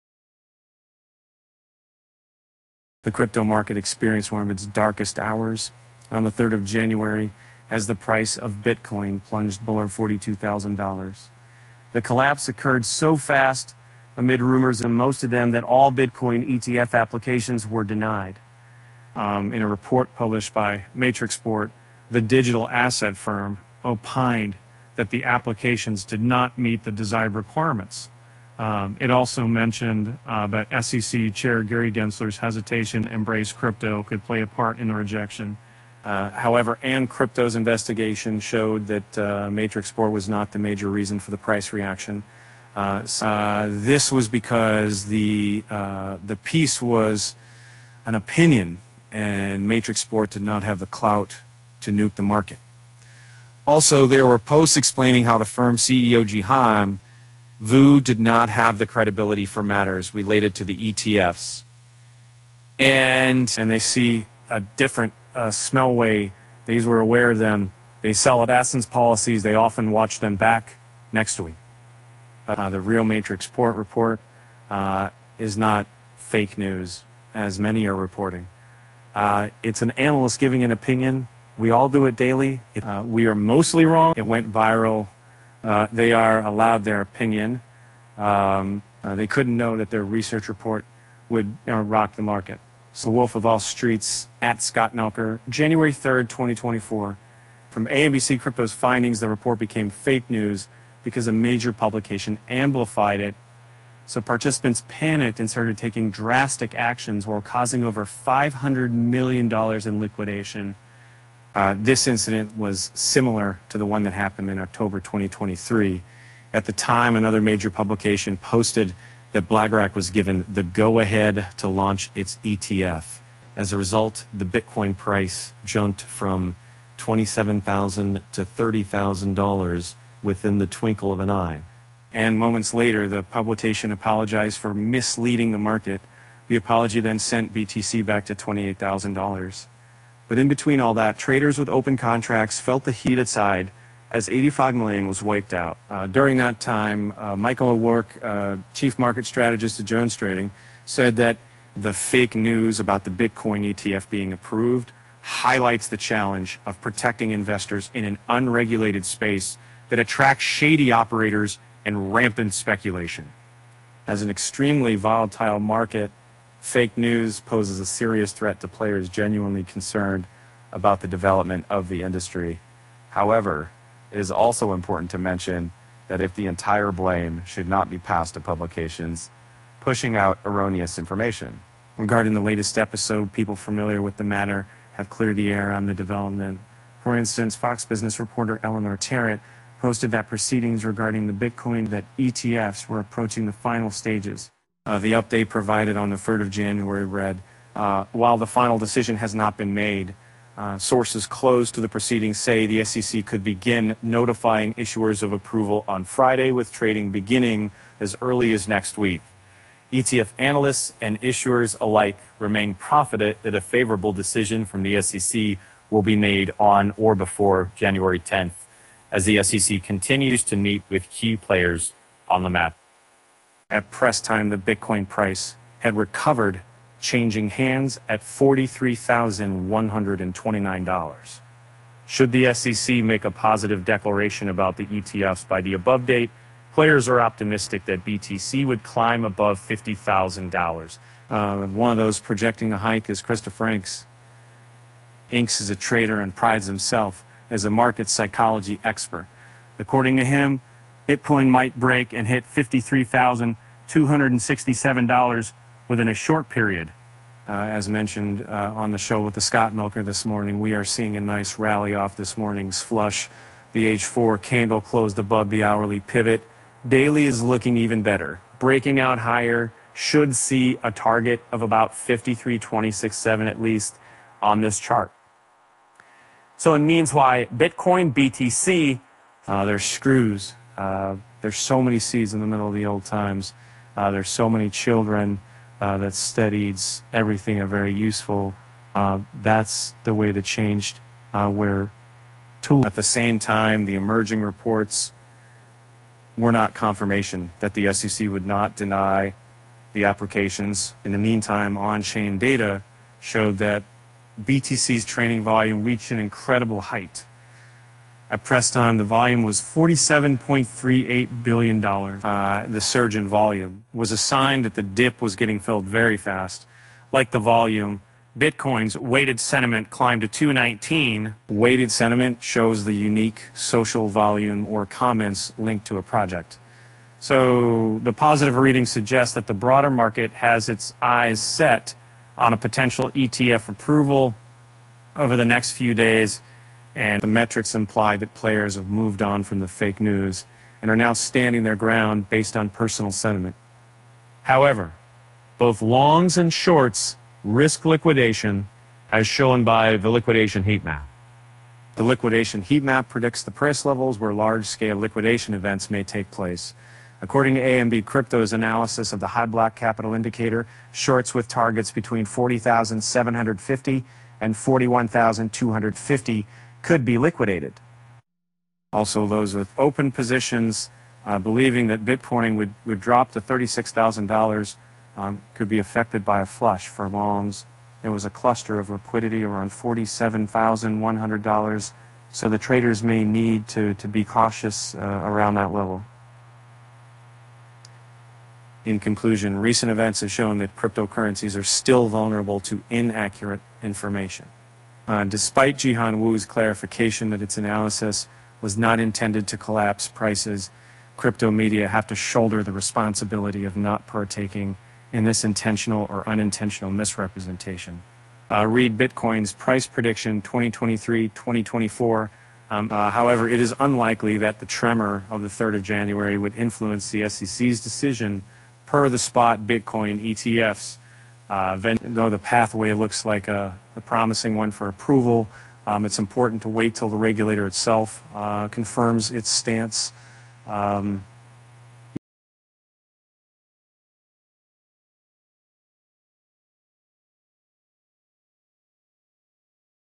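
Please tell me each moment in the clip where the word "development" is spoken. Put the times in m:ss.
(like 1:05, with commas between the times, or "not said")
2:51, 3:05.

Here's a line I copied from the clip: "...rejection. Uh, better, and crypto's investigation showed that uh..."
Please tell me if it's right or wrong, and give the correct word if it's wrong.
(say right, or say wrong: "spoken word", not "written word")
wrong: "however", not "better".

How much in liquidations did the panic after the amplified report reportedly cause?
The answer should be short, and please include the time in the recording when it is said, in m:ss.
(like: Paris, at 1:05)
$500 million, at 1:48.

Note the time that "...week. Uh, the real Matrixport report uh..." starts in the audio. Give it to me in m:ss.
1:11.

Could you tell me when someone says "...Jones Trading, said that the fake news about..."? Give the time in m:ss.
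2:29.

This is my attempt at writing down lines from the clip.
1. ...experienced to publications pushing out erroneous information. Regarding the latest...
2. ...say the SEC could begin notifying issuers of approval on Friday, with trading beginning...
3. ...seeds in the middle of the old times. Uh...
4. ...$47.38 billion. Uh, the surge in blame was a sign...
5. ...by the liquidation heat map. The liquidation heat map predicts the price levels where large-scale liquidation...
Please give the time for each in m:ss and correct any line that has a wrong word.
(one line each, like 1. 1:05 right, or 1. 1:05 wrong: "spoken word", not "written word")
1. 2:57 wrong: "passed", not "experienced"
2. 3:22 right
3. 4:41 right
4. 5:09 wrong: "volume", not "blame"
5. 5:49 right.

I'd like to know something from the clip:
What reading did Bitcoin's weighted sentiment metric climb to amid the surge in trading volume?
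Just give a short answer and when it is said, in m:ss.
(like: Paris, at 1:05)
219, at 5:20.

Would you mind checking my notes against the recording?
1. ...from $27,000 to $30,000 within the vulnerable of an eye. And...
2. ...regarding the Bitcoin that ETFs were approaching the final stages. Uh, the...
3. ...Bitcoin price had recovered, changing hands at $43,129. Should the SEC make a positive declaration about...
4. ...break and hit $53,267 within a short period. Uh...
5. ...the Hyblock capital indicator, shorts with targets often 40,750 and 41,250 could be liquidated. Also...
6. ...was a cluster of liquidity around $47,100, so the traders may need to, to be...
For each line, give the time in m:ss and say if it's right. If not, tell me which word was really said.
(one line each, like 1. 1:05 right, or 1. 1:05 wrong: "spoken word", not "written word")
1. 2:06 wrong: "twinkle", not "vulnerable"
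2. 3:10 right
3. 3:44 right
4. 4:11 right
5. 5:59 wrong: "between", not "often"
6. 6:18 right.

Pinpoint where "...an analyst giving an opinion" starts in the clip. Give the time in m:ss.
1:19.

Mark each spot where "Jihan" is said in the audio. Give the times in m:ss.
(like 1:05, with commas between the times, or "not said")
0:56, 6:35.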